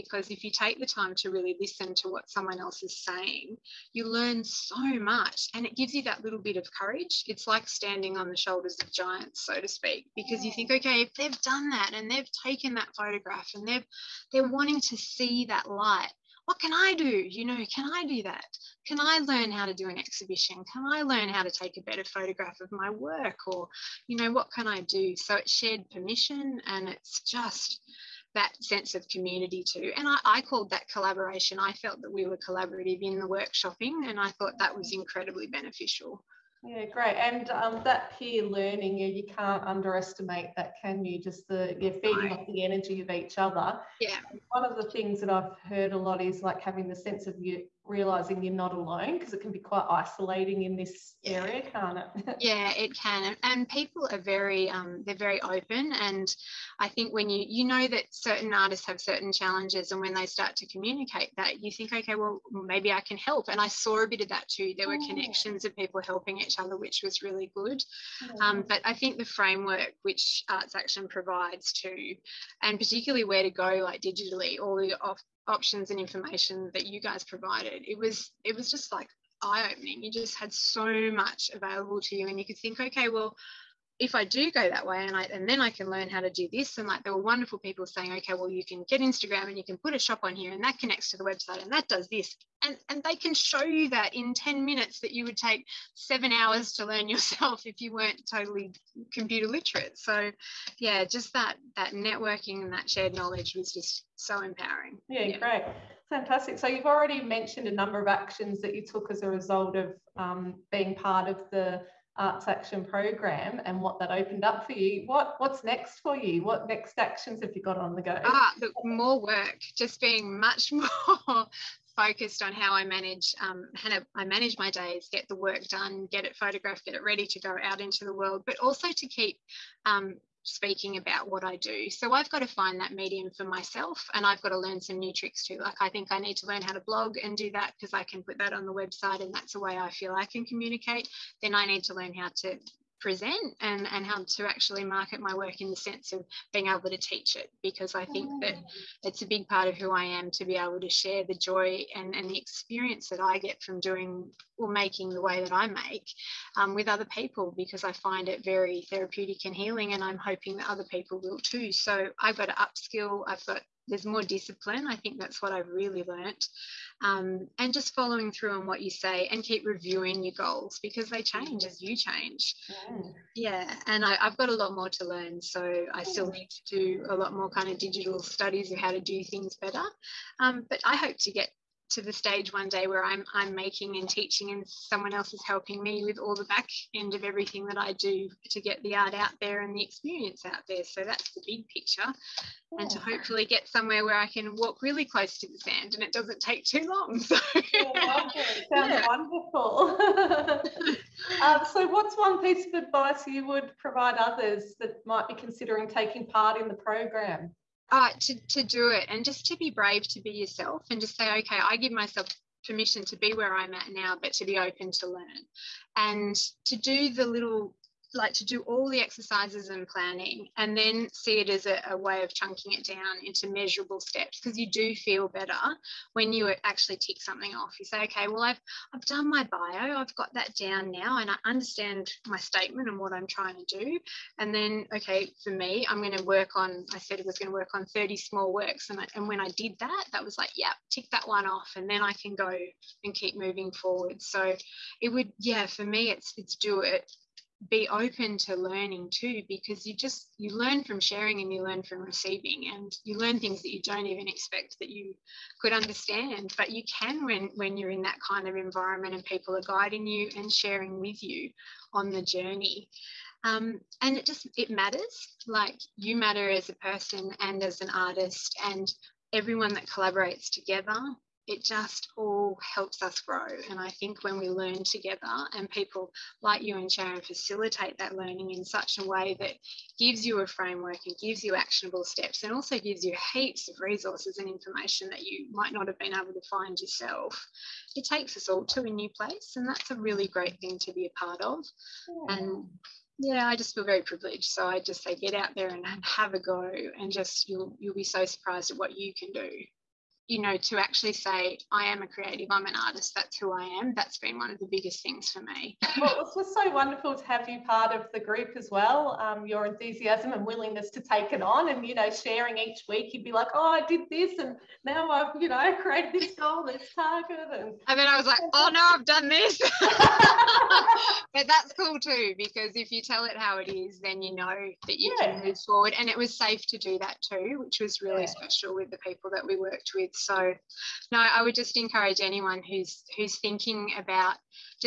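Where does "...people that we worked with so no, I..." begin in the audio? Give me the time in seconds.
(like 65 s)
328 s.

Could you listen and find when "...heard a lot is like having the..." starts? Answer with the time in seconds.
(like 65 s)
45 s.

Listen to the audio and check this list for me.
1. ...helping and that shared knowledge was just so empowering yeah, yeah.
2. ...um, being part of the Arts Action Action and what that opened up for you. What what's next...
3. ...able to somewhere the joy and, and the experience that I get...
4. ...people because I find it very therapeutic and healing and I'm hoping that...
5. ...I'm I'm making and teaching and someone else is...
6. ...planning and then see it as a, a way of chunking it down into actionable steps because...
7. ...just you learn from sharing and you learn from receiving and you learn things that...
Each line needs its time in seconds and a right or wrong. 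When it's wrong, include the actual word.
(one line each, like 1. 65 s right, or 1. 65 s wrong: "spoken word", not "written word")
1. 101 s wrong: "networking", not "helping"
2. 110 s wrong: "Program", not "Action"
3. 150 s wrong: "share", not "somewhere"
4. 157 s right
5. 183 s right
6. 219 s wrong: "measurable", not "actionable"
7. 249 s right.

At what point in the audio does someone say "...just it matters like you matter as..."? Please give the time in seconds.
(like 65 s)
264 s.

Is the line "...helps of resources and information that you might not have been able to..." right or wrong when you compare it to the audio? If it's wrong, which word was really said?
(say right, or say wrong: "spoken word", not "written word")
wrong: "heaps", not "helps".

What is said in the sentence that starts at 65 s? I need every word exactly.
connections of people helping each other which was really good oh.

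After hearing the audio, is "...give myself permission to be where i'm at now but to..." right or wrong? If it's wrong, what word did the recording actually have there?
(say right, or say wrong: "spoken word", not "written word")
right.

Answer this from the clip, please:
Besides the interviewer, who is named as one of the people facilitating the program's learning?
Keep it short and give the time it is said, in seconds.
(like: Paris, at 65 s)
Sharon, at 276 s.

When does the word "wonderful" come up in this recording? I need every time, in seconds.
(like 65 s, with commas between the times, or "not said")
87 s, 199 s, 306 s.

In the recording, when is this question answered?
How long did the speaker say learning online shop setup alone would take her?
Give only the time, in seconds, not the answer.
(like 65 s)
95 s.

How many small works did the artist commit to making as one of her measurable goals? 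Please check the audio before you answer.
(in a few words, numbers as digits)
30.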